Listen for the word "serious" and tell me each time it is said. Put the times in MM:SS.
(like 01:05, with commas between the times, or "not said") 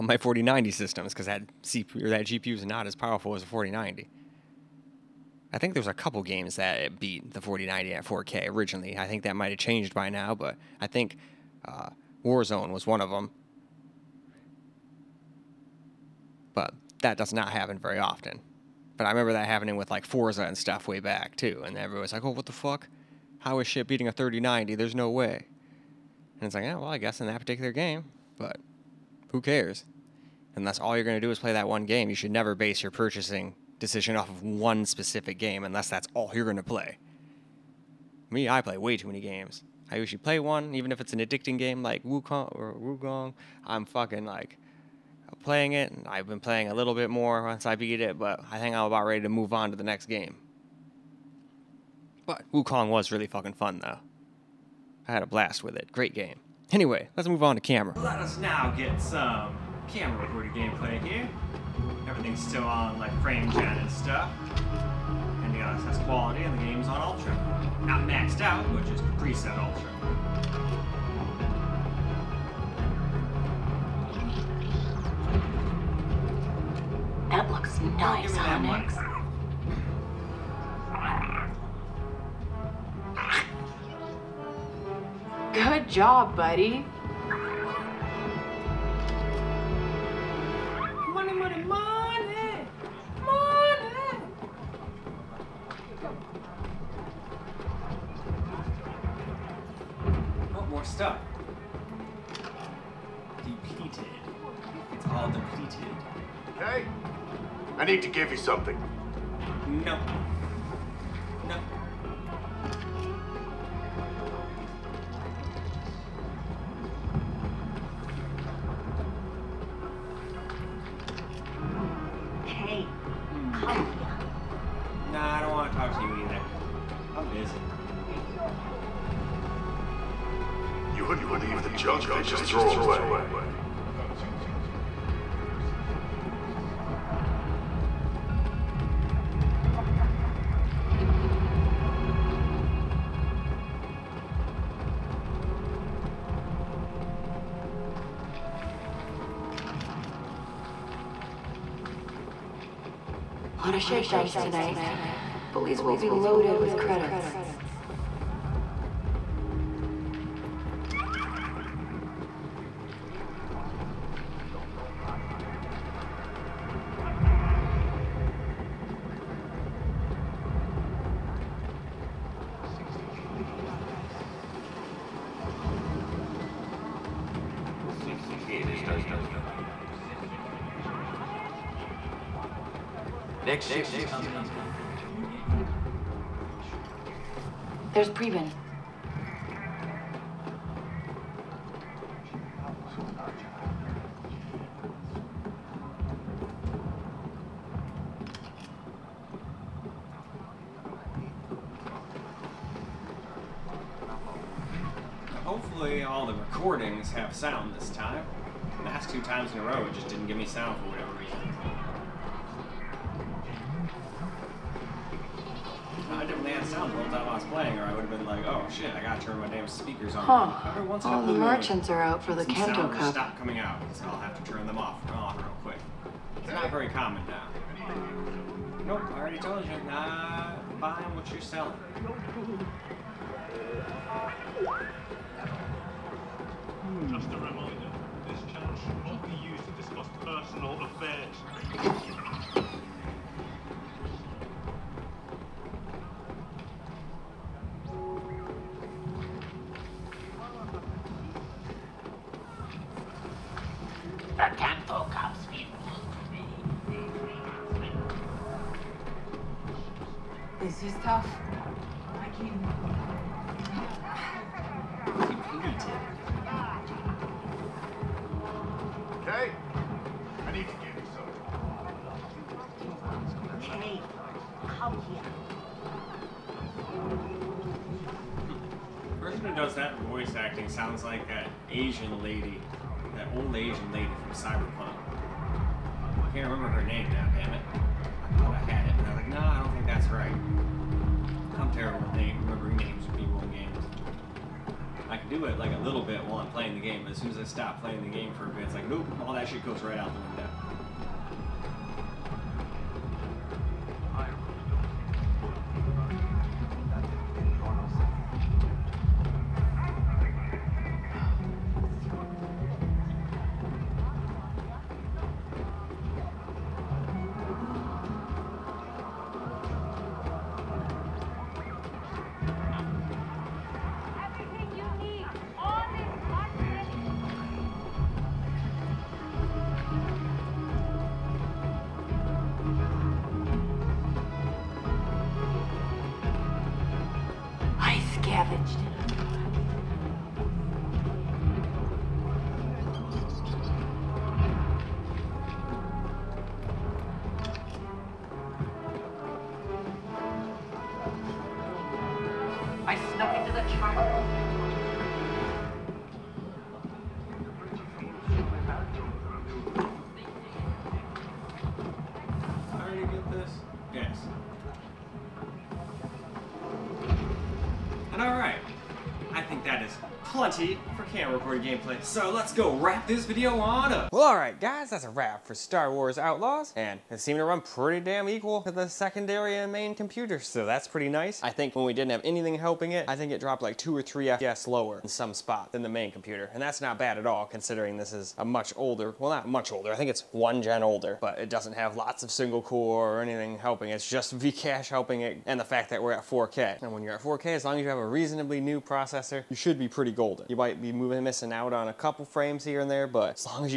not said.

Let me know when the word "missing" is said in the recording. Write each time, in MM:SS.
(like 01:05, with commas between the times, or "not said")
06:41.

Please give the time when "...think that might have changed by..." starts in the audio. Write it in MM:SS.
00:09.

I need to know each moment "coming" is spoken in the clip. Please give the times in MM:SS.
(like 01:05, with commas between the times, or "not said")
03:04, 03:43.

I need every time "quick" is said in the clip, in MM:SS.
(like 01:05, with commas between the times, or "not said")
03:45.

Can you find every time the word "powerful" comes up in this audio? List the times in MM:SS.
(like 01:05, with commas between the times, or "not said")
00:02.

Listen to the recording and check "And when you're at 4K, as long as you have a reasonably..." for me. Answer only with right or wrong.
right.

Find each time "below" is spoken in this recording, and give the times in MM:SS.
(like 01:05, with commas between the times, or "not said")
not said.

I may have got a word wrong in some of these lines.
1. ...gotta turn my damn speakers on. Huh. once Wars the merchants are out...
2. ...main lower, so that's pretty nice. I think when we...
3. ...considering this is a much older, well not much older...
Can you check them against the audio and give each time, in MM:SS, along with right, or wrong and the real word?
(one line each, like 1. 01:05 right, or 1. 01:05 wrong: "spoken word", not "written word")
1. 03:39 wrong: "All", not "Wars"
2. 06:19 wrong: "computer", not "lower"
3. 06:27 right.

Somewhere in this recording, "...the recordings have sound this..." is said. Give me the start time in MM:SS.
03:26.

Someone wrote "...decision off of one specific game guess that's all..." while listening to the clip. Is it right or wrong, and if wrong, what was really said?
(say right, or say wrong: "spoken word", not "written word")
wrong: "unless", not "guess".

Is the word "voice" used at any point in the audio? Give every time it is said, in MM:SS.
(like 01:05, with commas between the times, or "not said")
04:40.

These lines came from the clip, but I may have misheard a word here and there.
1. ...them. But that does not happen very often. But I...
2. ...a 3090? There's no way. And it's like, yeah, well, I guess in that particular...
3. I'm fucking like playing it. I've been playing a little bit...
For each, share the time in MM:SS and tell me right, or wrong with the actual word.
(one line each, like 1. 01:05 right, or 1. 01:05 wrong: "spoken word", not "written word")
1. 00:13 right
2. 00:24 right
3. 00:43 right.